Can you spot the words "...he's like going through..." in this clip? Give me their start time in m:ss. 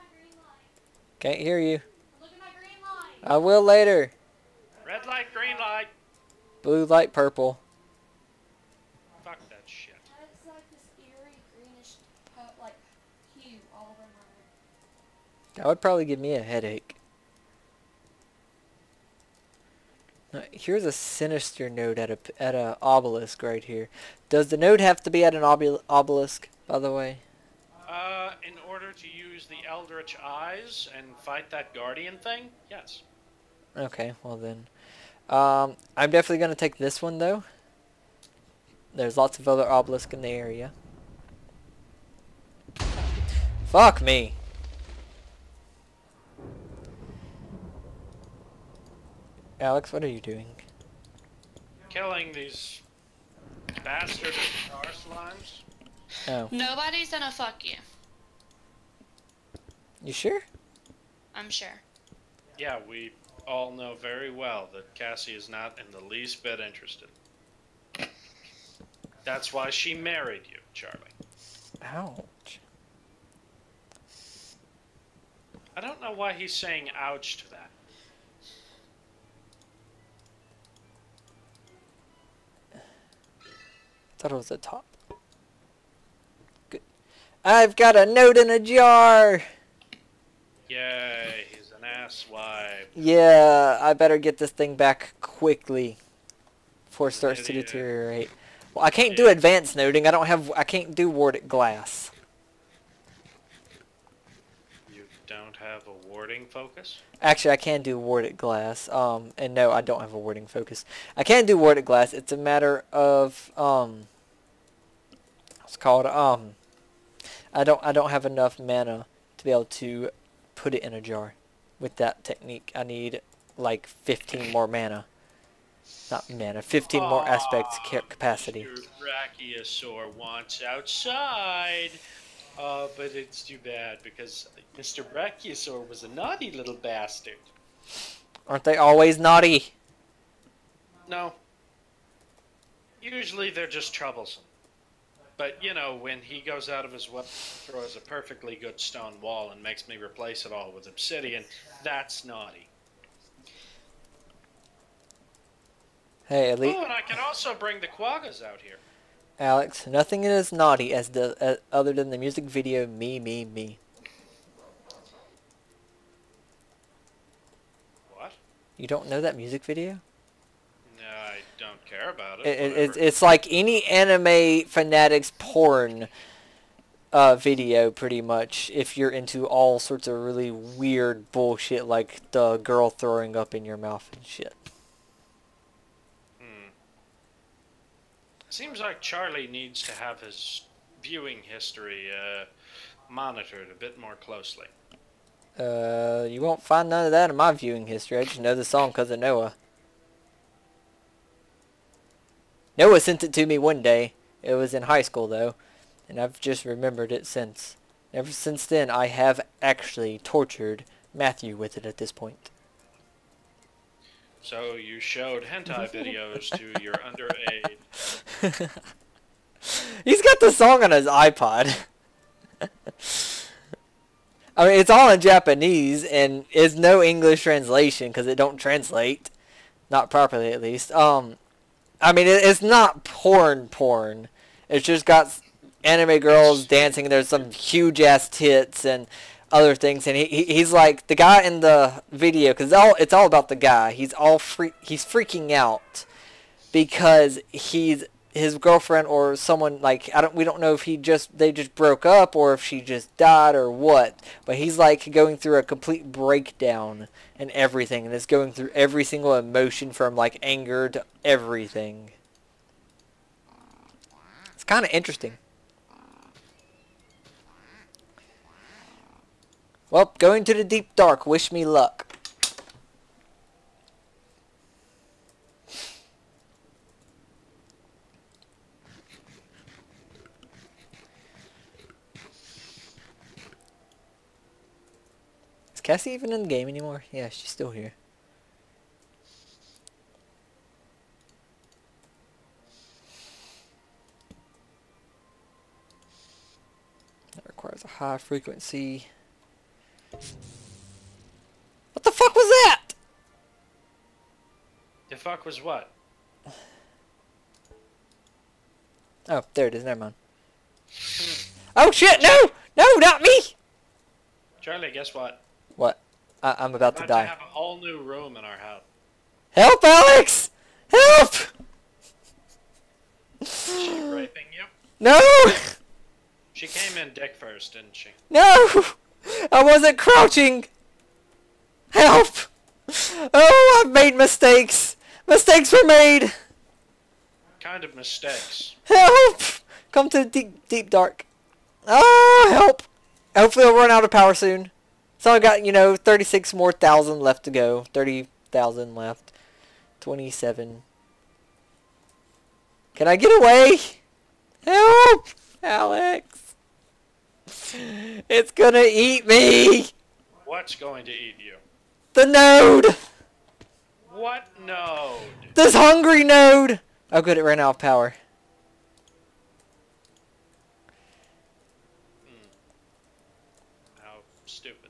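4:14.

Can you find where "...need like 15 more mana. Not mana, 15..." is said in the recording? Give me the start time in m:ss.
2:02.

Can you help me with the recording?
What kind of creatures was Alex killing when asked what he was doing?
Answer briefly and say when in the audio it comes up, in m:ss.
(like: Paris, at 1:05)
Star slimes, at 0:54.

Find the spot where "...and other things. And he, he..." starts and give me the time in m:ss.
3:58.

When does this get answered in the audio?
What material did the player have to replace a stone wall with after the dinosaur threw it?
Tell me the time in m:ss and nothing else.
2:30.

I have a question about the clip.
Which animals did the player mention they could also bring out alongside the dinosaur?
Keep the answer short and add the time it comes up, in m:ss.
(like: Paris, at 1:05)
Quaggas, at 2:37.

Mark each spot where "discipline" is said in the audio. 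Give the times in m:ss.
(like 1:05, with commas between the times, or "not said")
not said.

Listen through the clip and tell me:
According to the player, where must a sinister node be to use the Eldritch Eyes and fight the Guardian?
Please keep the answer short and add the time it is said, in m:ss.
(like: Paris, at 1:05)
An obelisk, at 0:22.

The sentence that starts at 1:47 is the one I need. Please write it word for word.
Actually, I can do warded glass.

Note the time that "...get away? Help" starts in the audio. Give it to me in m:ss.
5:53.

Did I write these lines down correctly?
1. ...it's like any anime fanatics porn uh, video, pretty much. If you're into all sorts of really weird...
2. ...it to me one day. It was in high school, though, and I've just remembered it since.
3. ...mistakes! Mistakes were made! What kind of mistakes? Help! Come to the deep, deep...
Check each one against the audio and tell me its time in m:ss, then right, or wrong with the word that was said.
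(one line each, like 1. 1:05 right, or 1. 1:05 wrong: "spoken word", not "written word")
1. 2:52 right
2. 3:23 right
3. 5:34 right.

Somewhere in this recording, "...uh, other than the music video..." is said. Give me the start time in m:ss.
2:41.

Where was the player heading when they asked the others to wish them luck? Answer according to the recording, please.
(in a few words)
The deep dark.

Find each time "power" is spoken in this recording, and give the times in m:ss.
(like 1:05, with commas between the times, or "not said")
5:44, 6:07.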